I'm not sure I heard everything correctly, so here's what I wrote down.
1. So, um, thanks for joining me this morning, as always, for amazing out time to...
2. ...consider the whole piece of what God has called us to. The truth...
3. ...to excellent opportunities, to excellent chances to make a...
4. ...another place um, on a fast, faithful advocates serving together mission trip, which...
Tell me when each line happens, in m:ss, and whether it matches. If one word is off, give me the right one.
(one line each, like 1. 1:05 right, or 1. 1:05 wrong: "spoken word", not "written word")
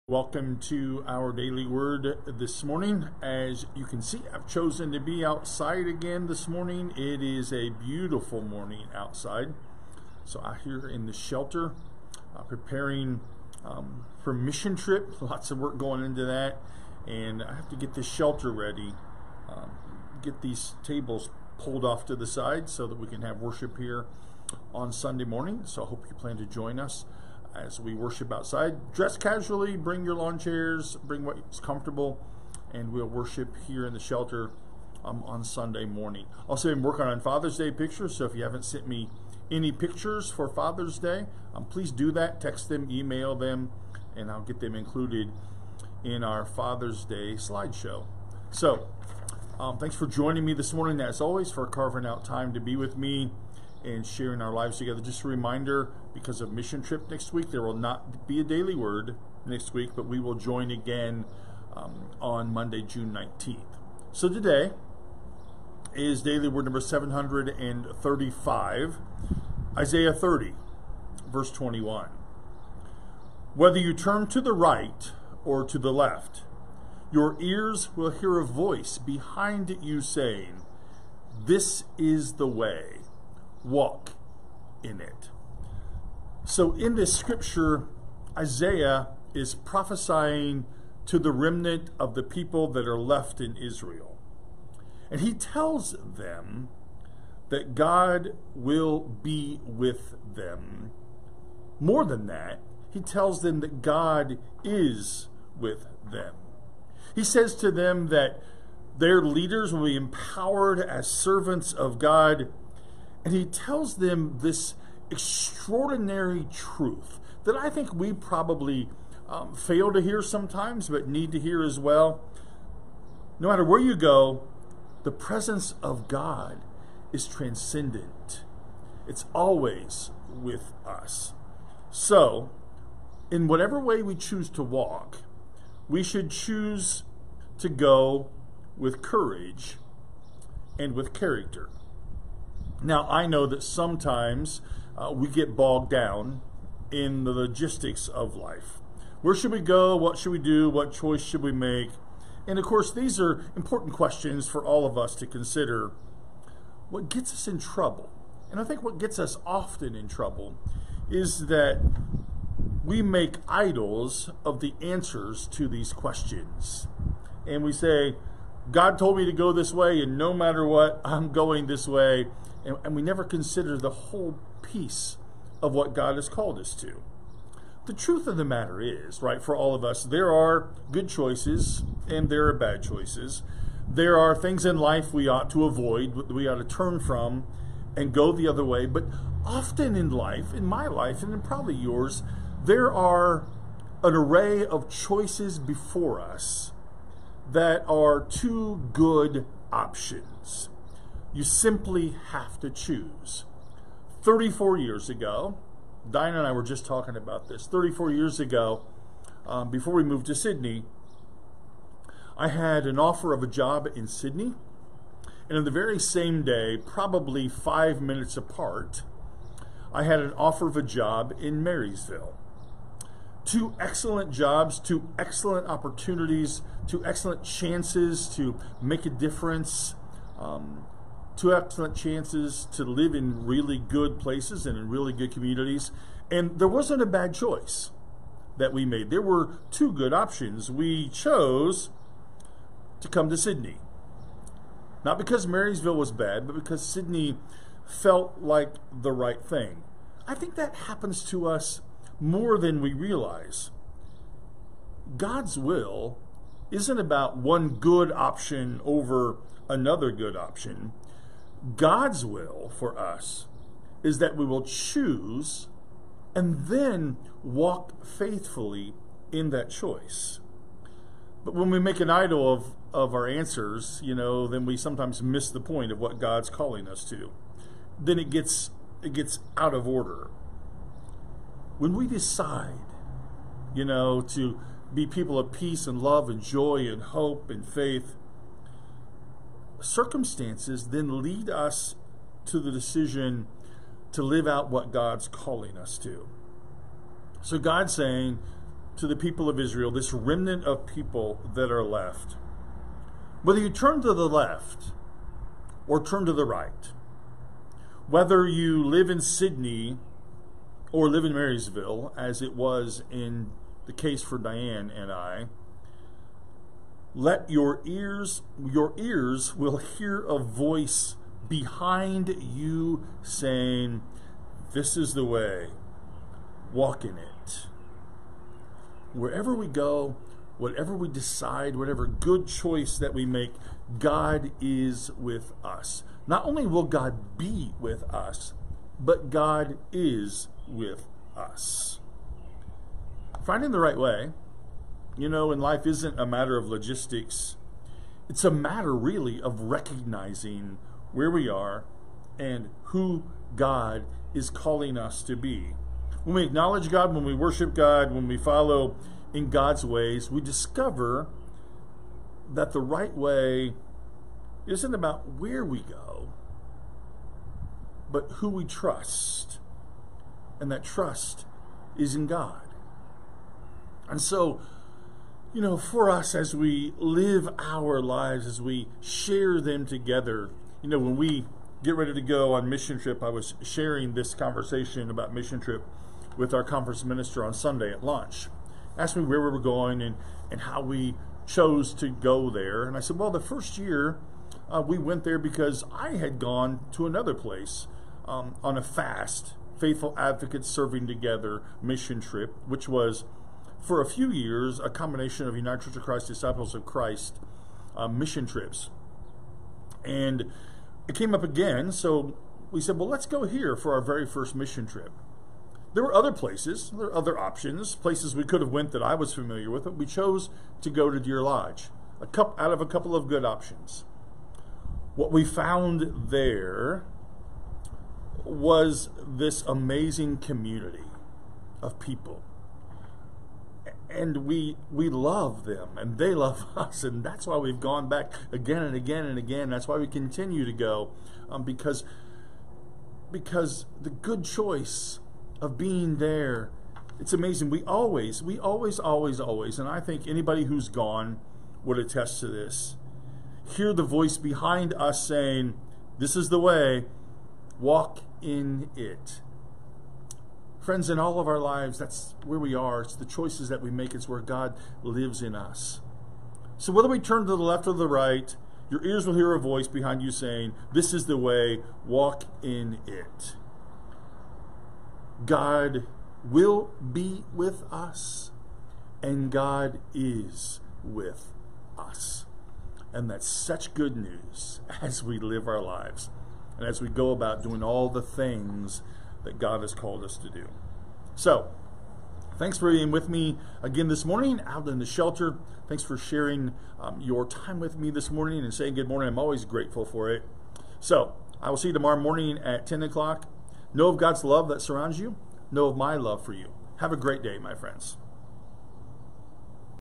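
1. 0:48 wrong: "carving", not "amazing"
2. 2:53 right
3. 3:44 right
4. 6:37 right.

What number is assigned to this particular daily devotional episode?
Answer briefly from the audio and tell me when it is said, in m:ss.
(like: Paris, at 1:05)
735, at 1:06.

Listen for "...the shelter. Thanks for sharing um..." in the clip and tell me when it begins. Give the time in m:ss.
8:14.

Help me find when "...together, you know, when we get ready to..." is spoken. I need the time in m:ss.
6:19.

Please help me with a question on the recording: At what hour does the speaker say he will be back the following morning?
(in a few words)
10 o'clock.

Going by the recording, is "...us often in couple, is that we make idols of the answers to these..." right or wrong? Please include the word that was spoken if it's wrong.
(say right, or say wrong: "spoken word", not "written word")
wrong: "trouble", not "couple".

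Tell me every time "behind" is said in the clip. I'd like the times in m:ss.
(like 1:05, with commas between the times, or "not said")
1:18, 5:21, 7:34, 7:49.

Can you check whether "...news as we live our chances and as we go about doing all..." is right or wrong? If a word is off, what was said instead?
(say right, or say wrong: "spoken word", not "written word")
wrong: "lives", not "chances".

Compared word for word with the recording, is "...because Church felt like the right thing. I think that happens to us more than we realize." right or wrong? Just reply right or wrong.
wrong.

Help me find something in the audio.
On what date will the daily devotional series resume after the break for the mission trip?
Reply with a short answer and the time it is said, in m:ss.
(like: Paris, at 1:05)
Monday, June 19th, at 1:02.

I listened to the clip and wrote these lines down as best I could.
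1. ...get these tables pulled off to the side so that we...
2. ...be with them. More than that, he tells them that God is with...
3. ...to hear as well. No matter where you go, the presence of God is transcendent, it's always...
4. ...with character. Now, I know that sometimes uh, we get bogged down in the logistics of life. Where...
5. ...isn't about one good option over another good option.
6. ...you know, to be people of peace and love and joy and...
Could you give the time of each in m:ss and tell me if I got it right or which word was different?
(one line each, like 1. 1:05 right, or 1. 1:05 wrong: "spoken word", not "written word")
1. 0:20 right
2. 1:39 right
3. 2:01 right
4. 2:20 right
5. 4:16 right
6. 4:43 right.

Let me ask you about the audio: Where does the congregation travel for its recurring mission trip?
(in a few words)
Deer Lodge.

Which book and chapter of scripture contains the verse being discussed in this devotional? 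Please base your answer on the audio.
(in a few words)
Isaiah 30.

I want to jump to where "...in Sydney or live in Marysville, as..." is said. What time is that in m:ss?
5:09.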